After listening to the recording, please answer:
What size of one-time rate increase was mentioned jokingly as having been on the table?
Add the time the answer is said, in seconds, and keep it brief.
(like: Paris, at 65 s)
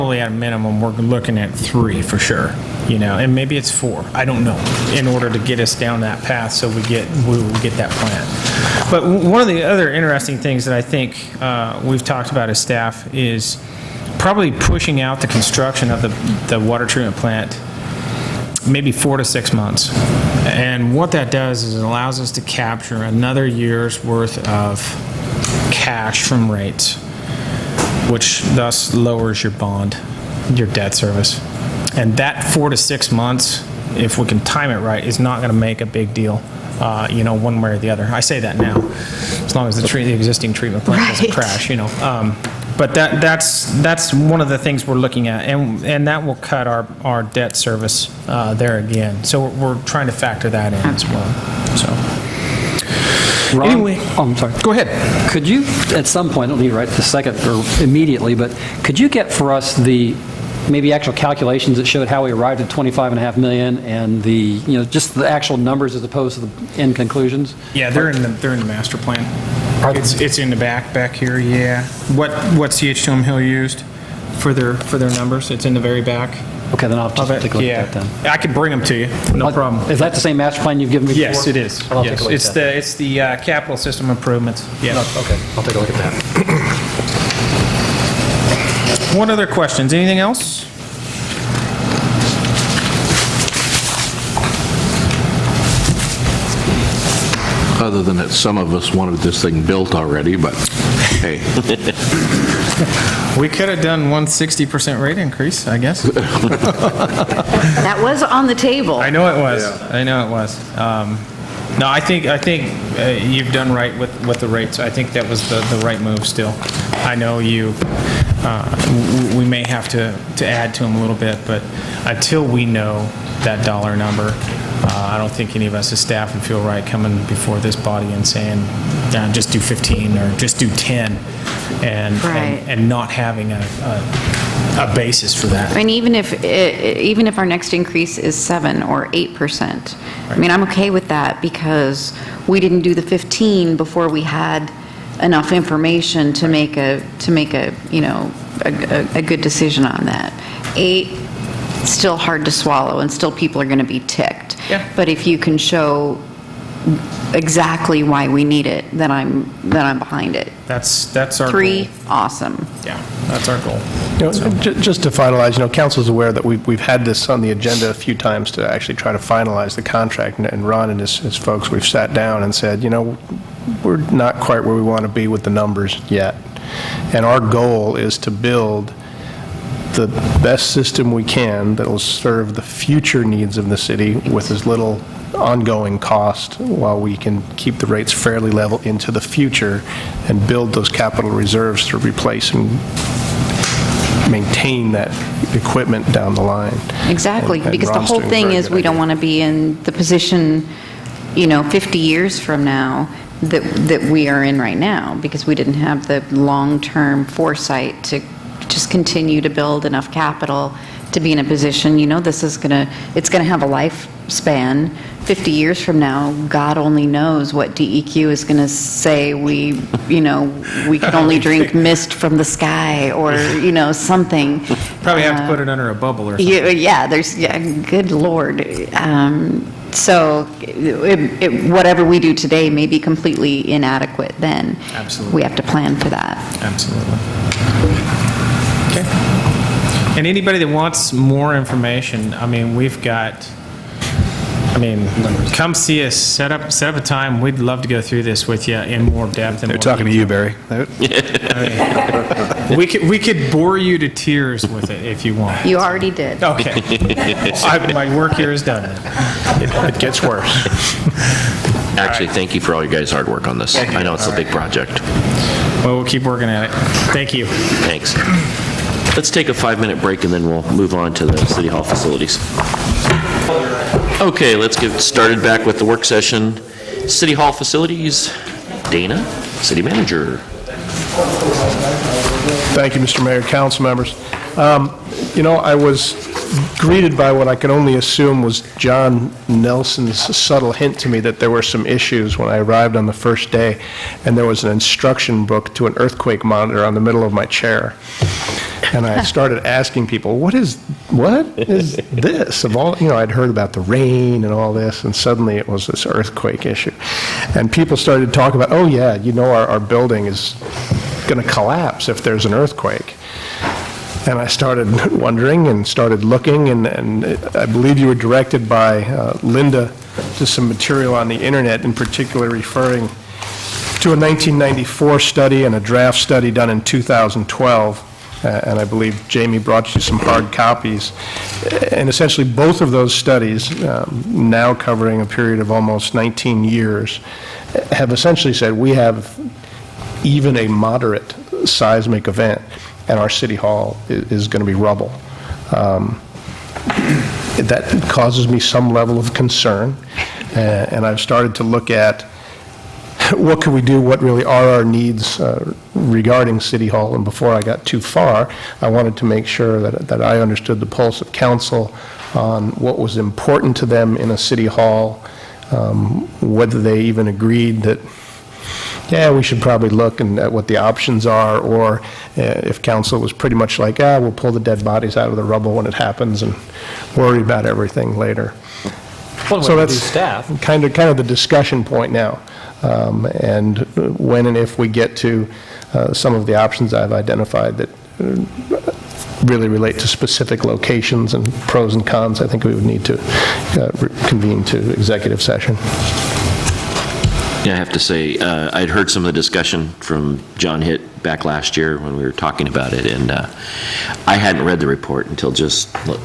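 60 percent, at 104 s.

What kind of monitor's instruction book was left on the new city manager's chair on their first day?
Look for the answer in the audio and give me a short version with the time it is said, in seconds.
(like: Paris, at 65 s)
Earthquake monitor, at 295 s.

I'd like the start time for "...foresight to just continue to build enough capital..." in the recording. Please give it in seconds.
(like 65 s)
207 s.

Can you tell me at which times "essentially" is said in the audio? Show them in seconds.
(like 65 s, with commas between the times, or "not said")
332 s, 338 s.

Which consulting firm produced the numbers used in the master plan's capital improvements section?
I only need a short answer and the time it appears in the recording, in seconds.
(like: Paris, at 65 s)
CH2M Hill, at 72 s.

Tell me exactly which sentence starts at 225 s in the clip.
Probably have uh, to put it under a bubble or something.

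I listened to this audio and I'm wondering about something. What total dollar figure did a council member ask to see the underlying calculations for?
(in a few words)
25.5 million.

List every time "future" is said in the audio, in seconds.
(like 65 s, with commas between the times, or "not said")
182 s, 189 s.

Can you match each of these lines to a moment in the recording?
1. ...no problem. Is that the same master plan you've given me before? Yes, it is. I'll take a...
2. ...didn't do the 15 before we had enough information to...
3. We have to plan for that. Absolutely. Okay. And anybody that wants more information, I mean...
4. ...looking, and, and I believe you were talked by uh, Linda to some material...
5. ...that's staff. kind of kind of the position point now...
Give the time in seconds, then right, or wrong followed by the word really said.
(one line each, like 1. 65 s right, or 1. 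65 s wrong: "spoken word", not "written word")
1. 79 s right
2. 142 s right
3. 235 s right
4. 316 s wrong: "directed", not "talked"
5. 379 s wrong: "discussion", not "position".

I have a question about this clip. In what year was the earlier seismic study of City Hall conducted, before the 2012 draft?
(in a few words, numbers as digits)
1994.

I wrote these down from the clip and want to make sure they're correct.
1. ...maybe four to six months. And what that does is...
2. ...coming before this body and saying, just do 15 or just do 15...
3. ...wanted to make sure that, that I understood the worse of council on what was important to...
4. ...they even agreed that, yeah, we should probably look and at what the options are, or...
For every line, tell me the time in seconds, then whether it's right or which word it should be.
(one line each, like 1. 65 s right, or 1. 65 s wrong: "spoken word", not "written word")
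1. 18 s right
2. 126 s wrong: "10", not "15"
3. 358 s wrong: "pulse", not "worse"
4. 366 s right.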